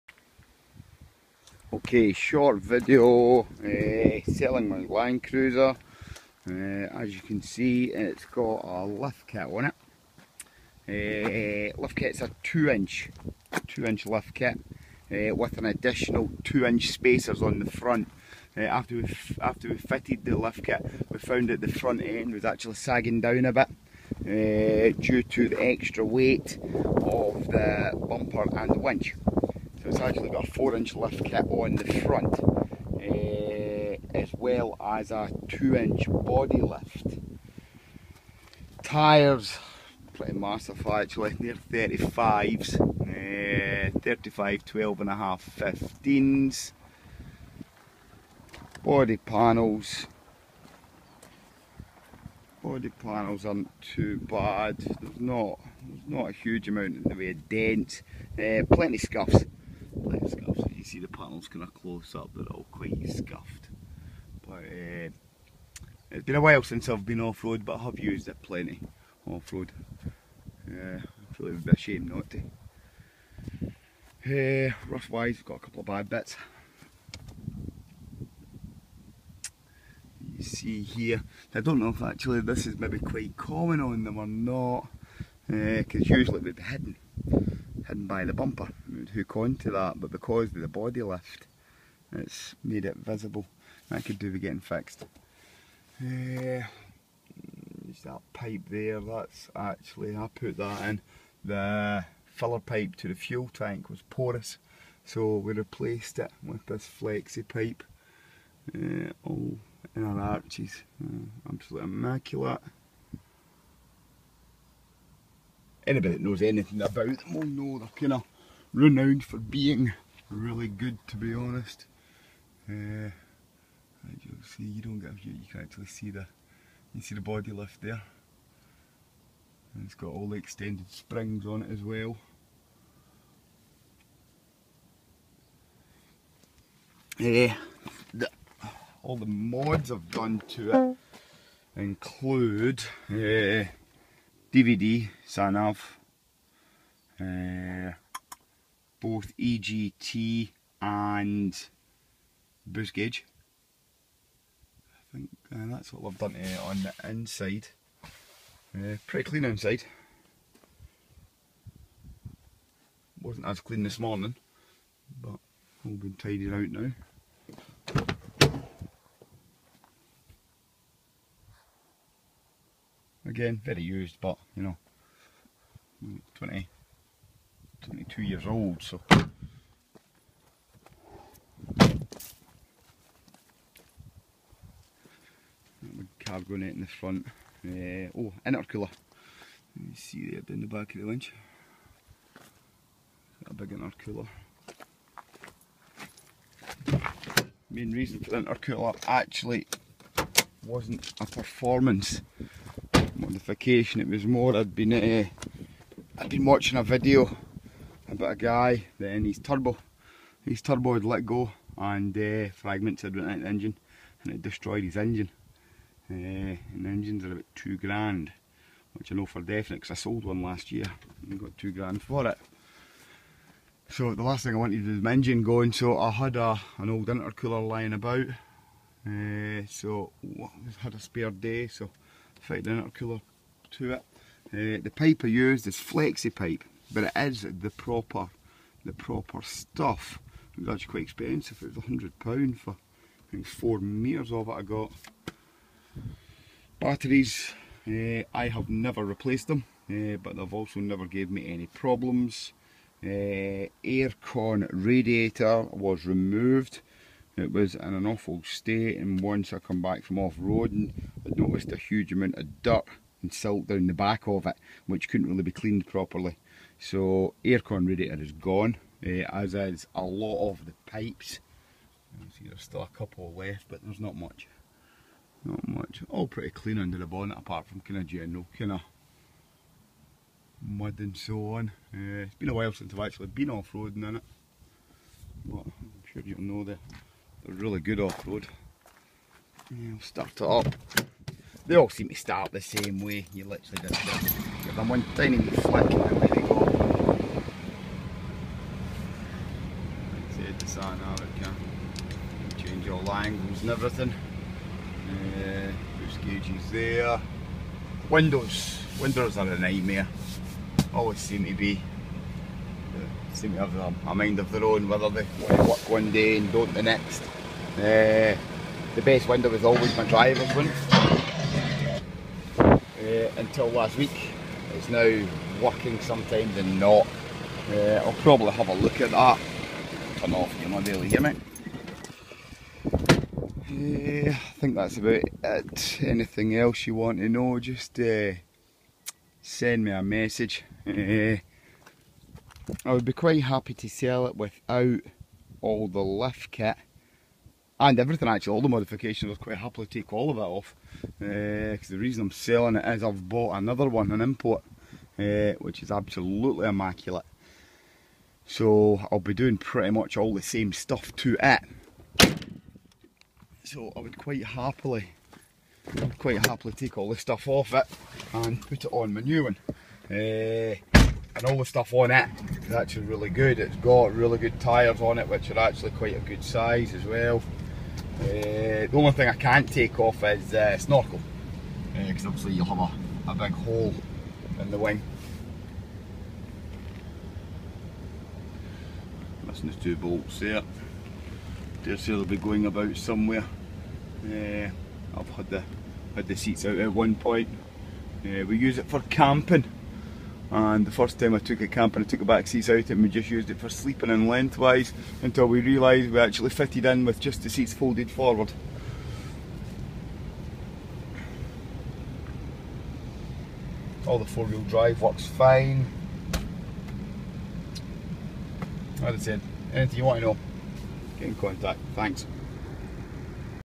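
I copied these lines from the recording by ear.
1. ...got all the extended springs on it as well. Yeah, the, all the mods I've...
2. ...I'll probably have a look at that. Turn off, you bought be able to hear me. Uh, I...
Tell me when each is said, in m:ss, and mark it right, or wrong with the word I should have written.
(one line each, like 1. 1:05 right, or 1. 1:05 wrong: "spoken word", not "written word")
1. 2:09 right
2. 5:28 wrong: "might", not "bought".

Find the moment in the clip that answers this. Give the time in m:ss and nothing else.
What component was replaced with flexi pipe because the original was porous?
1:41.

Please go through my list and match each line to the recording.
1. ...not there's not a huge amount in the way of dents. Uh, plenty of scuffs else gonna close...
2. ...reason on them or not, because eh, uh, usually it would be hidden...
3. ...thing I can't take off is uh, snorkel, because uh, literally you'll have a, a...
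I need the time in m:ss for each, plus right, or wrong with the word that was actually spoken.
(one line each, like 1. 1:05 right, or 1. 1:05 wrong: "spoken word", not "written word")
1. 0:55 right
2. 1:23 wrong: "common", not "reason"
3. 6:19 wrong: "obviously", not "literally".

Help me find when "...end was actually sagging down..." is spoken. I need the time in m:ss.
0:22.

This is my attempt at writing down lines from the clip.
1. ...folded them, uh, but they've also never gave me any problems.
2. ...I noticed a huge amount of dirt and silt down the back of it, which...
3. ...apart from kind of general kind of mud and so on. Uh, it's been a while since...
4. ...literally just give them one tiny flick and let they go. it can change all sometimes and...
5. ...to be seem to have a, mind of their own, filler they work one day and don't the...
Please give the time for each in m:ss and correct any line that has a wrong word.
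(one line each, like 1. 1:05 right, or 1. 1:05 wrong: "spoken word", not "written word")
1. 4:09 wrong: "replaced", not "folded"
2. 4:21 right
3. 4:37 right
4. 4:53 wrong: "angles", not "sometimes"
5. 5:11 wrong: "whether", not "filler".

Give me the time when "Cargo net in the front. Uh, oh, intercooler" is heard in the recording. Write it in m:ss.
3:06.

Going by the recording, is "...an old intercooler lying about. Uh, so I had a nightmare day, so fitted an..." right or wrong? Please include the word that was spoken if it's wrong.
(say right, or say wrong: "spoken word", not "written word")
wrong: "spare", not "nightmare".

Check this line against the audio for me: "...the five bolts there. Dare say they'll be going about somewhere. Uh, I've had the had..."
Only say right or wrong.
wrong.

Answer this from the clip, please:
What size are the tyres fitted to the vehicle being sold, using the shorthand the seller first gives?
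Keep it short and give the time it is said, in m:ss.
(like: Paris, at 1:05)
35s, at 0:41.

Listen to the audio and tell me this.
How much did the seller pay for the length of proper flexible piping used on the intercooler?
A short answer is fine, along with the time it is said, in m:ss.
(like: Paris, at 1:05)
£100, at 4:01.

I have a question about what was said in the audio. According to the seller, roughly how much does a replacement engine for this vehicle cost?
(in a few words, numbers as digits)
2 grand.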